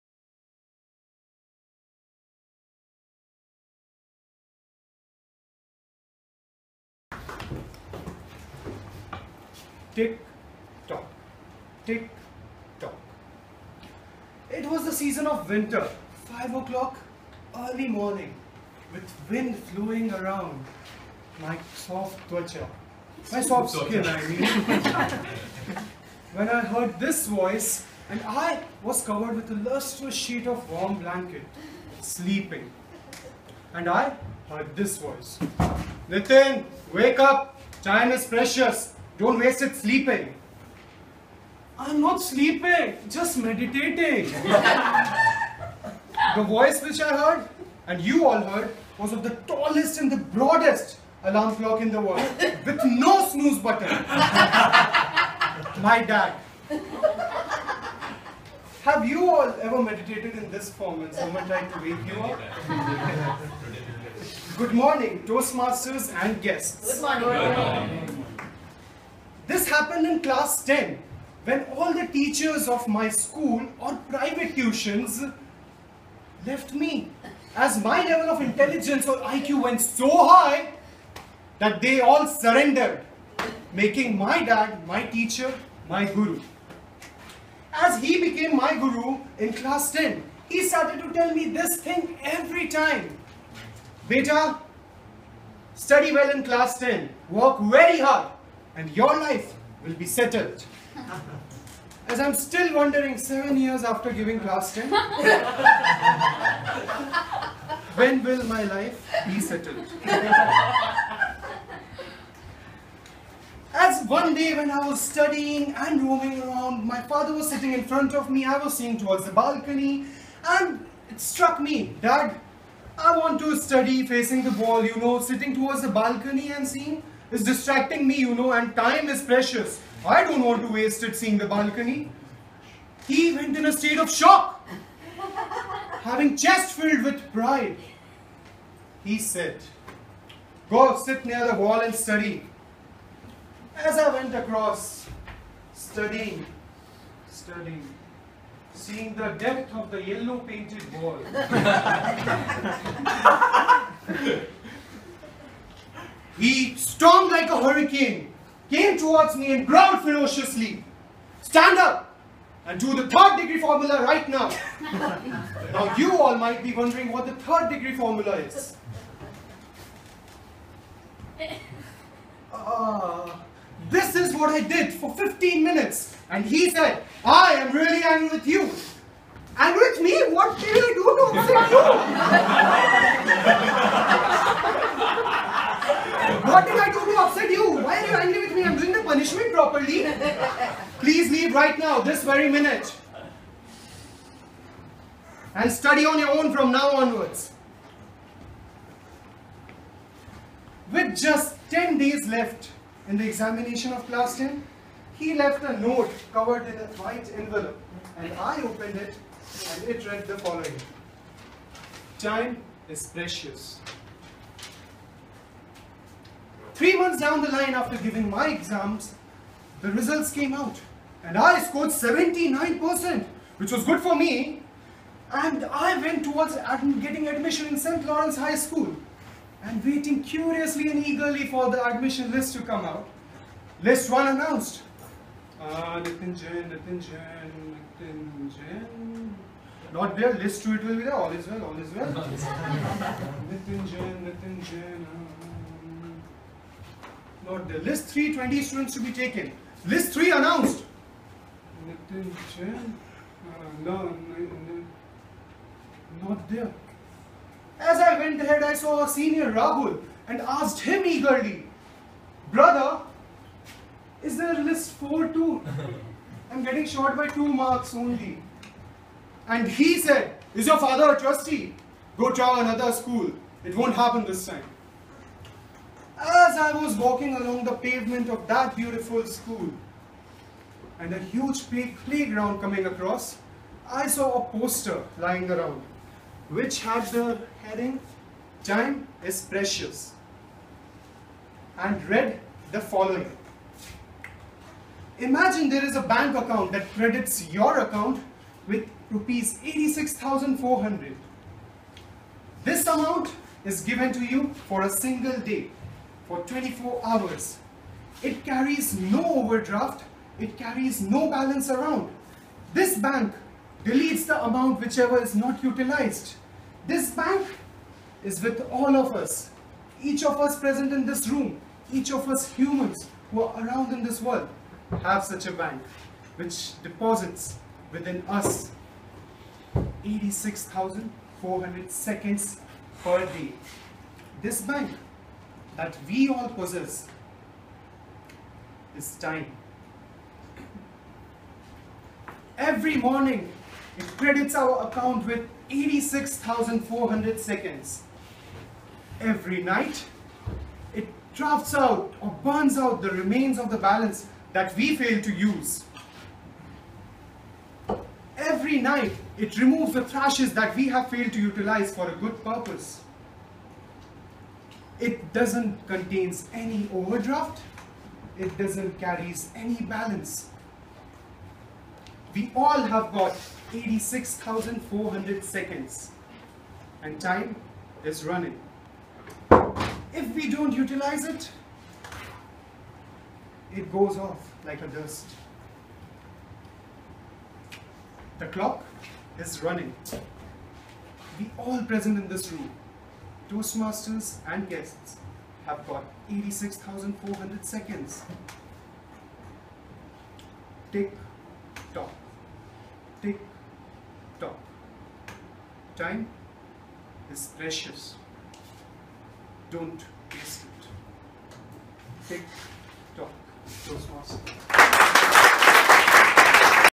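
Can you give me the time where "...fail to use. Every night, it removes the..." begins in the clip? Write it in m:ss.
5:54.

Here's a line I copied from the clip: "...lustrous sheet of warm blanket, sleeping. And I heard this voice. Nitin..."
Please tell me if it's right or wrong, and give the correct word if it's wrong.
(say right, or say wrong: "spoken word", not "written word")
right.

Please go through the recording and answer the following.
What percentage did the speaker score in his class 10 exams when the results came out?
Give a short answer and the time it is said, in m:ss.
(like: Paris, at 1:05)
79%, at 3:41.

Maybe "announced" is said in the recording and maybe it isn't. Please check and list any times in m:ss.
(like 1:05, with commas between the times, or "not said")
3:54, 4:10.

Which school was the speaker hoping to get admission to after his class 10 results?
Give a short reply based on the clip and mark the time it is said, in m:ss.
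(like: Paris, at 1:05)
St. Lawrence High School, at 3:47.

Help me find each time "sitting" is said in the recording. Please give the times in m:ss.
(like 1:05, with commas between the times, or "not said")
1:57, 2:05.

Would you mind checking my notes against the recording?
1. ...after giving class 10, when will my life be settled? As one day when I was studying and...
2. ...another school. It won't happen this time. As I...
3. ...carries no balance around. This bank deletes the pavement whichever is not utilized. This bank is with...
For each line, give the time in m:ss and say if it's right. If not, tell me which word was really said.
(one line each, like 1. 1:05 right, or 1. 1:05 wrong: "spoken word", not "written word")
1. 1:43 right
2. 4:32 right
3. 5:10 wrong: "amount", not "pavement".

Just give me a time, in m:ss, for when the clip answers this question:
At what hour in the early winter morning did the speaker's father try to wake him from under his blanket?
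0:16.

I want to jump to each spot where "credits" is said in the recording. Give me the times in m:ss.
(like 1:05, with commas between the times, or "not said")
4:56, 5:44.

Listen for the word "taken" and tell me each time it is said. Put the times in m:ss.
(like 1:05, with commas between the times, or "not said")
4:09.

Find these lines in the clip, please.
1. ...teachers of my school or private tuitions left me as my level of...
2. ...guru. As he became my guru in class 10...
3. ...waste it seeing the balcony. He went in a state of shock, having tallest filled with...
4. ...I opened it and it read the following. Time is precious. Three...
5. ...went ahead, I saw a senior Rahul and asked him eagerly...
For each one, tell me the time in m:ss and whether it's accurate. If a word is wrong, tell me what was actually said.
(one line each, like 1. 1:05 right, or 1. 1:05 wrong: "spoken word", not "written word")
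1. 1:12 right
2. 1:26 right
3. 2:10 wrong: "chest", not "tallest"
4. 3:28 right
5. 4:18 right.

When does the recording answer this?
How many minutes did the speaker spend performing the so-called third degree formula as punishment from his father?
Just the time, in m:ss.
2:55.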